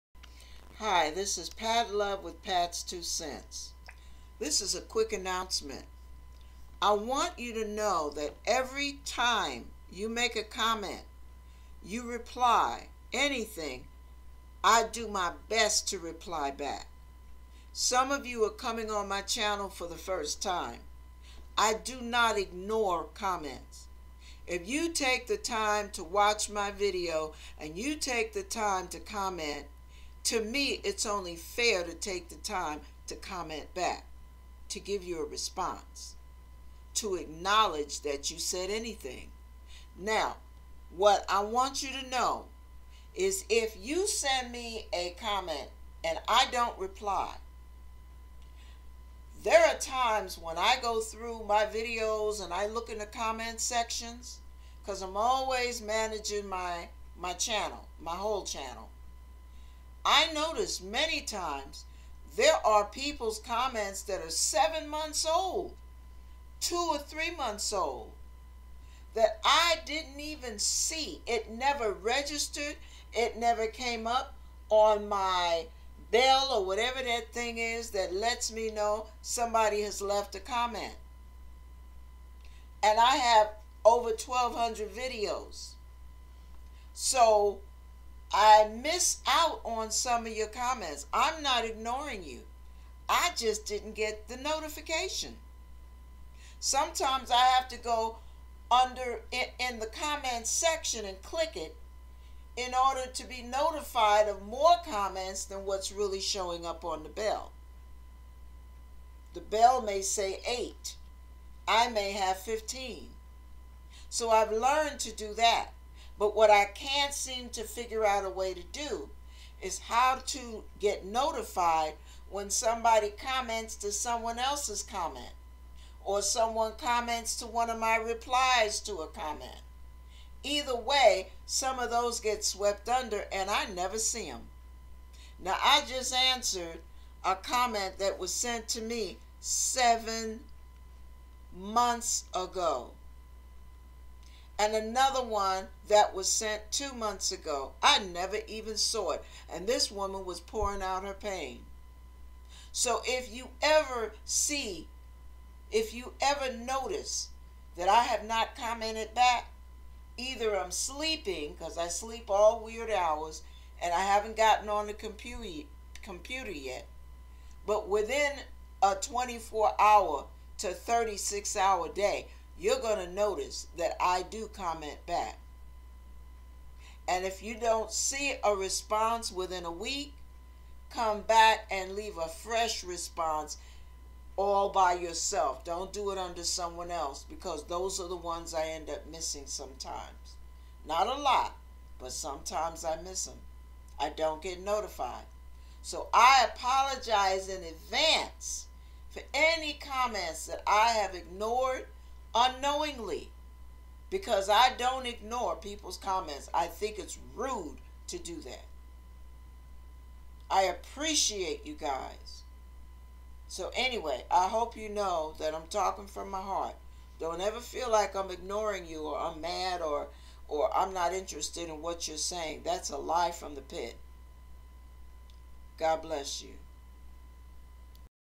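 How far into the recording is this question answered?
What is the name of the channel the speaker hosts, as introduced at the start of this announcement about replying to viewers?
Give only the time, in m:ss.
0:02.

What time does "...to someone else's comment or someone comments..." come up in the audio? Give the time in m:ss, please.
2:03.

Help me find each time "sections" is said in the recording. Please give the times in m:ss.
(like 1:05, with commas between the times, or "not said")
0:53, 1:40.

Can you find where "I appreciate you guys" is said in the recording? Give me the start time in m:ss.
3:30.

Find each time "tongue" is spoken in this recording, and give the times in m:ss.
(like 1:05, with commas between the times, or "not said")
not said.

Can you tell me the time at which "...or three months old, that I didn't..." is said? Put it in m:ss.
1:06.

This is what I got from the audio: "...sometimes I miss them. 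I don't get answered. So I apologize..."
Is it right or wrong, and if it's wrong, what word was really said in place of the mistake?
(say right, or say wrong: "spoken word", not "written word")
wrong: "notified", not "answered".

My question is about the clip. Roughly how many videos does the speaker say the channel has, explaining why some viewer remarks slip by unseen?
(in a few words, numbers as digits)
over 1,200.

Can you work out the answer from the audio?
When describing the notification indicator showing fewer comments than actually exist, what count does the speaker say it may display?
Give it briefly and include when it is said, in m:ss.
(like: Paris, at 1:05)
8, at 1:50.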